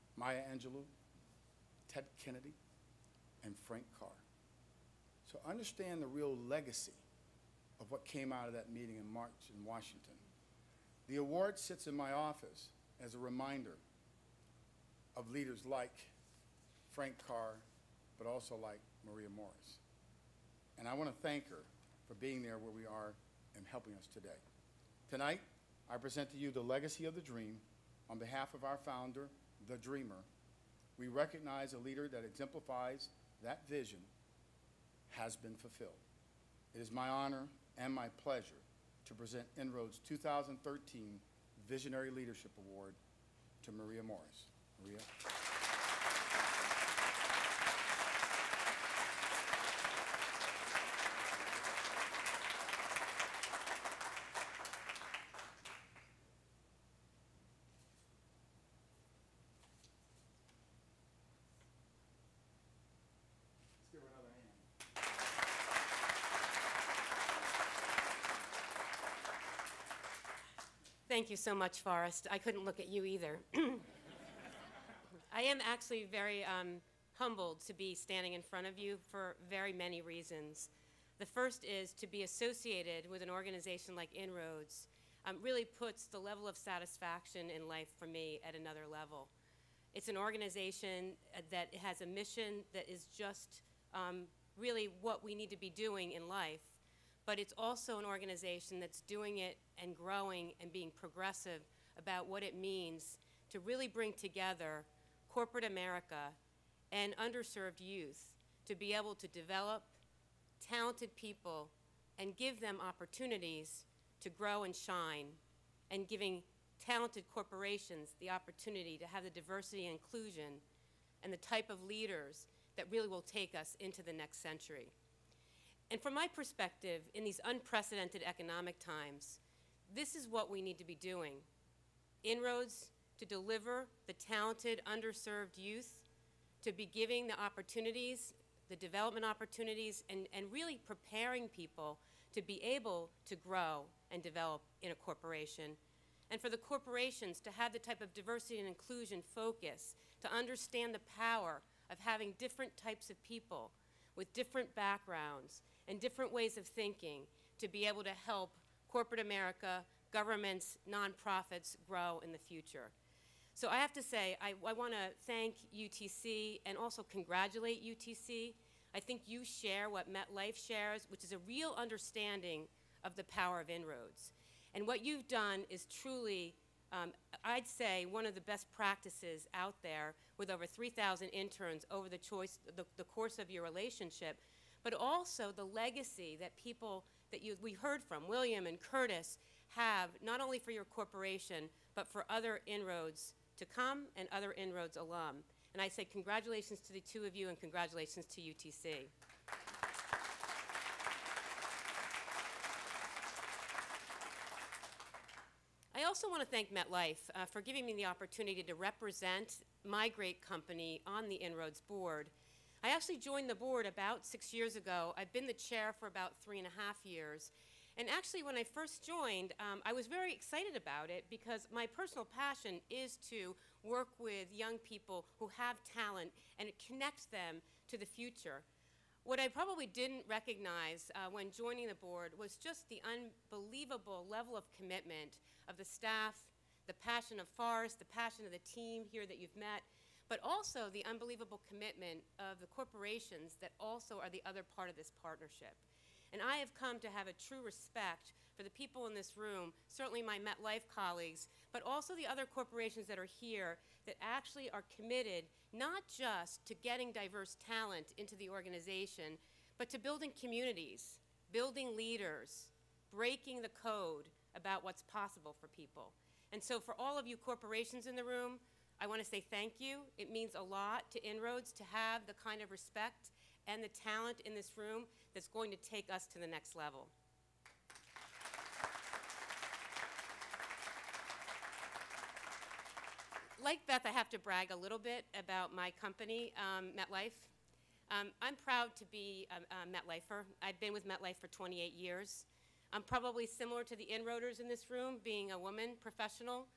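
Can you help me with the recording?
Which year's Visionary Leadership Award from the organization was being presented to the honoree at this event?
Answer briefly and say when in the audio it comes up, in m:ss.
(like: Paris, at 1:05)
2013, at 0:40.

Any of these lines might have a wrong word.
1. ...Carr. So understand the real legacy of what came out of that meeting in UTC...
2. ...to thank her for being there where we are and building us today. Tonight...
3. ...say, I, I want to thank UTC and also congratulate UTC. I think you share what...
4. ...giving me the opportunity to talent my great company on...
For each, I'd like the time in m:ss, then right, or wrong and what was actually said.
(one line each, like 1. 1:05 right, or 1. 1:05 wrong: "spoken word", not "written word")
1. 0:03 wrong: "March", not "UTC"
2. 0:21 wrong: "helping", not "building"
3. 2:44 right
4. 3:27 wrong: "represent", not "talent".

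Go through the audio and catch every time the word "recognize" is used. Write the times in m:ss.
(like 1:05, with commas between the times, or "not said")
0:31, 3:50.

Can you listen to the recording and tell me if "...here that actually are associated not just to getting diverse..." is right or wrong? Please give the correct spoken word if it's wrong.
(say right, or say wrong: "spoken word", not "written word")
wrong: "committed", not "associated".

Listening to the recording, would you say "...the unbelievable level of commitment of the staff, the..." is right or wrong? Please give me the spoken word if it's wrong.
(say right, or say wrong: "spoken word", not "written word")
right.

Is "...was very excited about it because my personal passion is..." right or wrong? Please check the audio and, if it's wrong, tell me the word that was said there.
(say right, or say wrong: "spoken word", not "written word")
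right.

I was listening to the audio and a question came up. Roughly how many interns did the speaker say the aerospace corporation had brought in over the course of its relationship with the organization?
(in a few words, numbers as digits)
3,000.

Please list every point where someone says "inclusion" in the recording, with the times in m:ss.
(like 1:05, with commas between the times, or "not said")
2:00, 2:28.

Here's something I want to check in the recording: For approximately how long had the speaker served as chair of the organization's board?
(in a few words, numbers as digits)
three and a half years.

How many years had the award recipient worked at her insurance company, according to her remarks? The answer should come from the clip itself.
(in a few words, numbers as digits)
28.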